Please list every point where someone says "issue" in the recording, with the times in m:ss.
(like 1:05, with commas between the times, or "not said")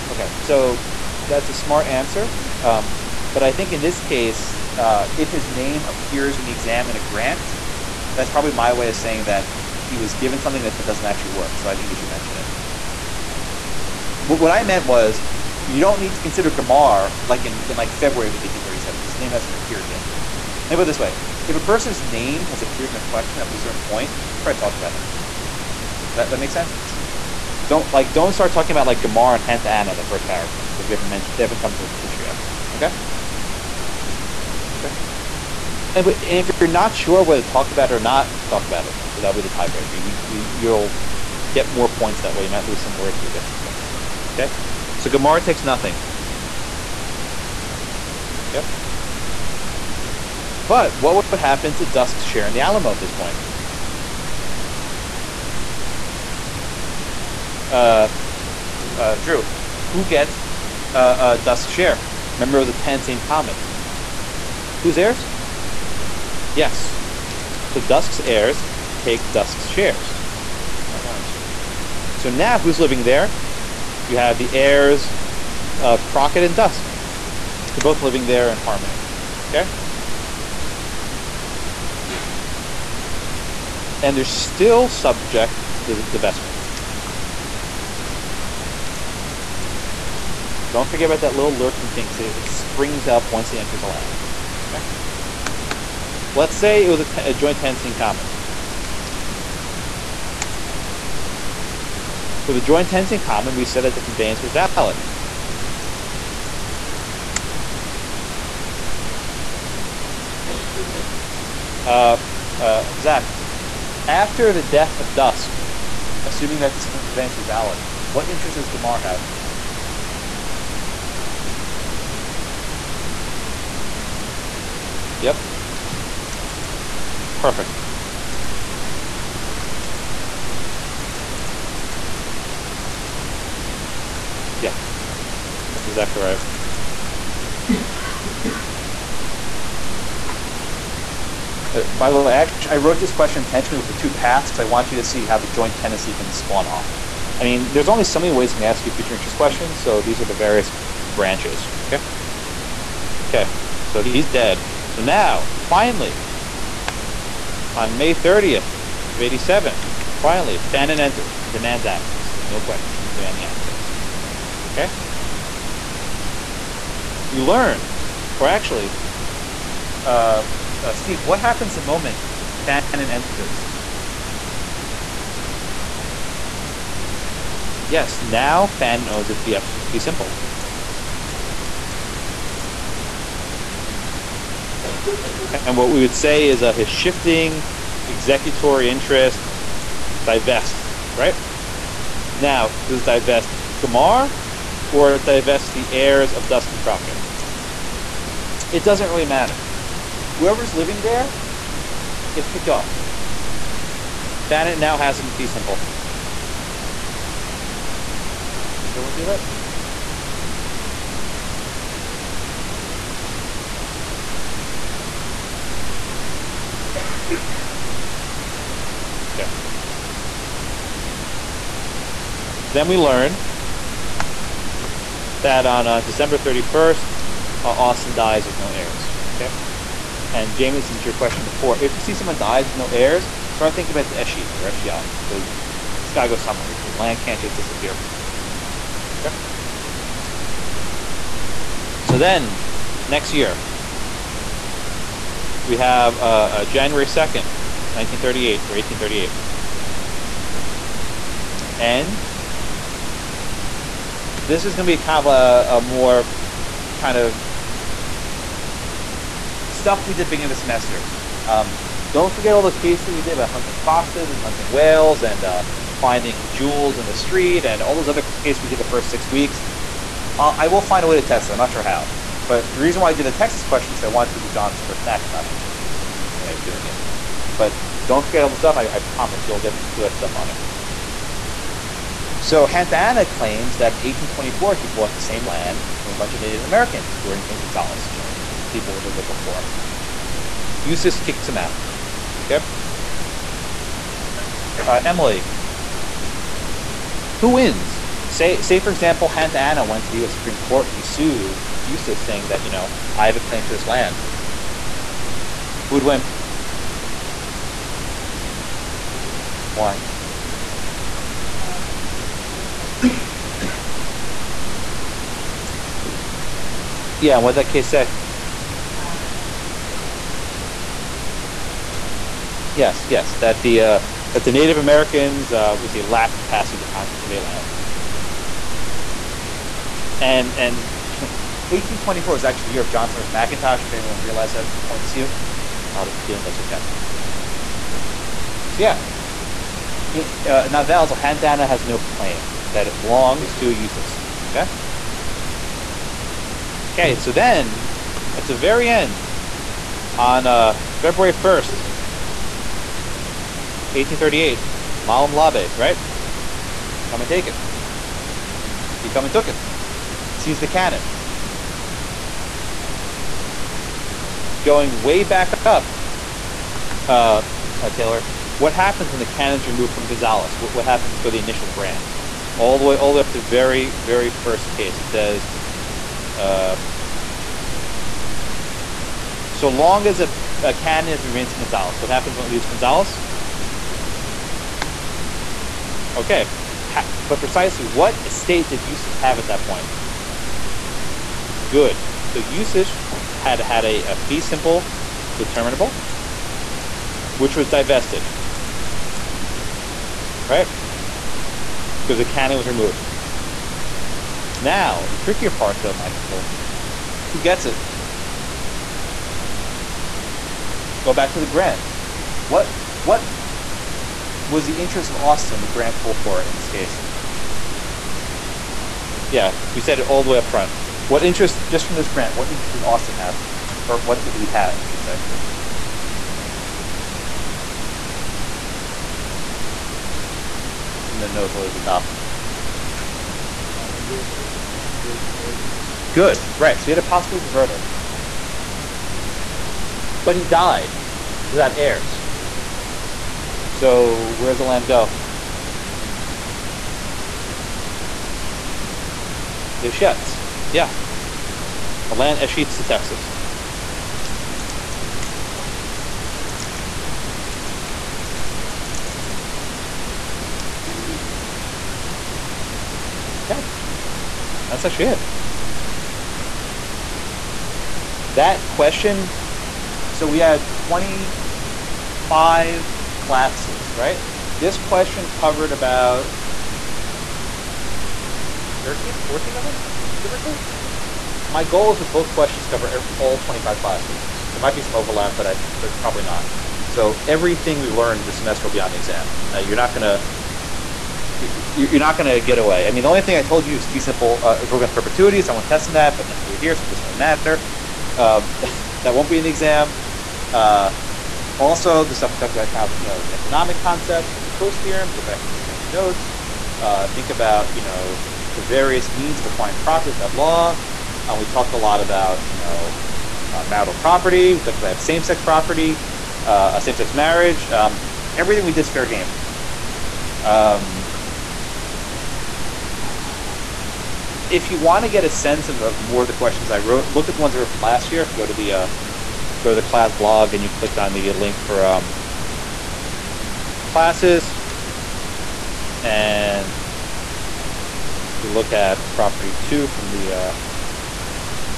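0:32, 4:35.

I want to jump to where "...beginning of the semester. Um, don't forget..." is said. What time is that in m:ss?
4:20.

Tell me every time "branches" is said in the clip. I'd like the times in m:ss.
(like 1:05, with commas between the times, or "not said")
2:31.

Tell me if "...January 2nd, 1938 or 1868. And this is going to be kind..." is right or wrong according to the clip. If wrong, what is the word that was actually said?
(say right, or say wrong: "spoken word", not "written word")
wrong: "1838", not "1868".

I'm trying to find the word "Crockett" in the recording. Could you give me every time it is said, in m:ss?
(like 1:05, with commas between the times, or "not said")
1:16, 3:16.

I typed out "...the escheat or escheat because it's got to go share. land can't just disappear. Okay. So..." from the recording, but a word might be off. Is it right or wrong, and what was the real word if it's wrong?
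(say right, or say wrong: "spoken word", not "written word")
wrong: "somewhere", not "share".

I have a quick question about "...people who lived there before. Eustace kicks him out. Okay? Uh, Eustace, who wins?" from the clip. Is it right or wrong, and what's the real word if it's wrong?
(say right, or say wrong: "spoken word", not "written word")
wrong: "Emily", not "Eustace".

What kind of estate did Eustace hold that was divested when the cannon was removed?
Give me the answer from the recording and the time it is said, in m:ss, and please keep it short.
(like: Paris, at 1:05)
fee simple determinable, at 6:34.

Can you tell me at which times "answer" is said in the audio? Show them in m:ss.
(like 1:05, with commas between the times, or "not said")
0:01.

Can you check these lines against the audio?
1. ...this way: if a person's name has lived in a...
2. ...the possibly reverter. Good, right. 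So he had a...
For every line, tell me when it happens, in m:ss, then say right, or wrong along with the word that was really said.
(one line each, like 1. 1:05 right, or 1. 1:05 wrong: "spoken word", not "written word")
1. 0:20 wrong: "appeared", not "lived"
2. 7:14 right.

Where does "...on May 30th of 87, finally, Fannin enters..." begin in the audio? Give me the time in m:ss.
2:37.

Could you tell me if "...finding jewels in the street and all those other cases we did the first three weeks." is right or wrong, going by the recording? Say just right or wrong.
wrong.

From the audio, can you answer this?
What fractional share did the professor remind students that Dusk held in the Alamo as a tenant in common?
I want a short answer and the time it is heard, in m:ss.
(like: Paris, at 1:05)
a tenth, at 1:02.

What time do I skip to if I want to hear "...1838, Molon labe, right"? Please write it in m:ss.
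5:53.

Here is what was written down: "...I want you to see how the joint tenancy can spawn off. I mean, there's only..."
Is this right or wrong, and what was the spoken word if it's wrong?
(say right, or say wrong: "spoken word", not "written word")
right.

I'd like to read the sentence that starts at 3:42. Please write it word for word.
So then we learn that on uh, December 31st, uh, Austin dies with no heirs.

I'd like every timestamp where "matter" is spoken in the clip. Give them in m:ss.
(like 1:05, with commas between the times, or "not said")
3:19, 8:17.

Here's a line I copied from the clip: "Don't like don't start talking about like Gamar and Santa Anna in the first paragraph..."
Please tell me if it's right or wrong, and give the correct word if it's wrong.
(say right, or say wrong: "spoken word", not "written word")
right.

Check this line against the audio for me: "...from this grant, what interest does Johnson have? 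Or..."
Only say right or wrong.
wrong.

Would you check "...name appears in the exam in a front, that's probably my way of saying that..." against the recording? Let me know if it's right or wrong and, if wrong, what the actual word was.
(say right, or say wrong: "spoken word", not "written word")
wrong: "grant", not "front".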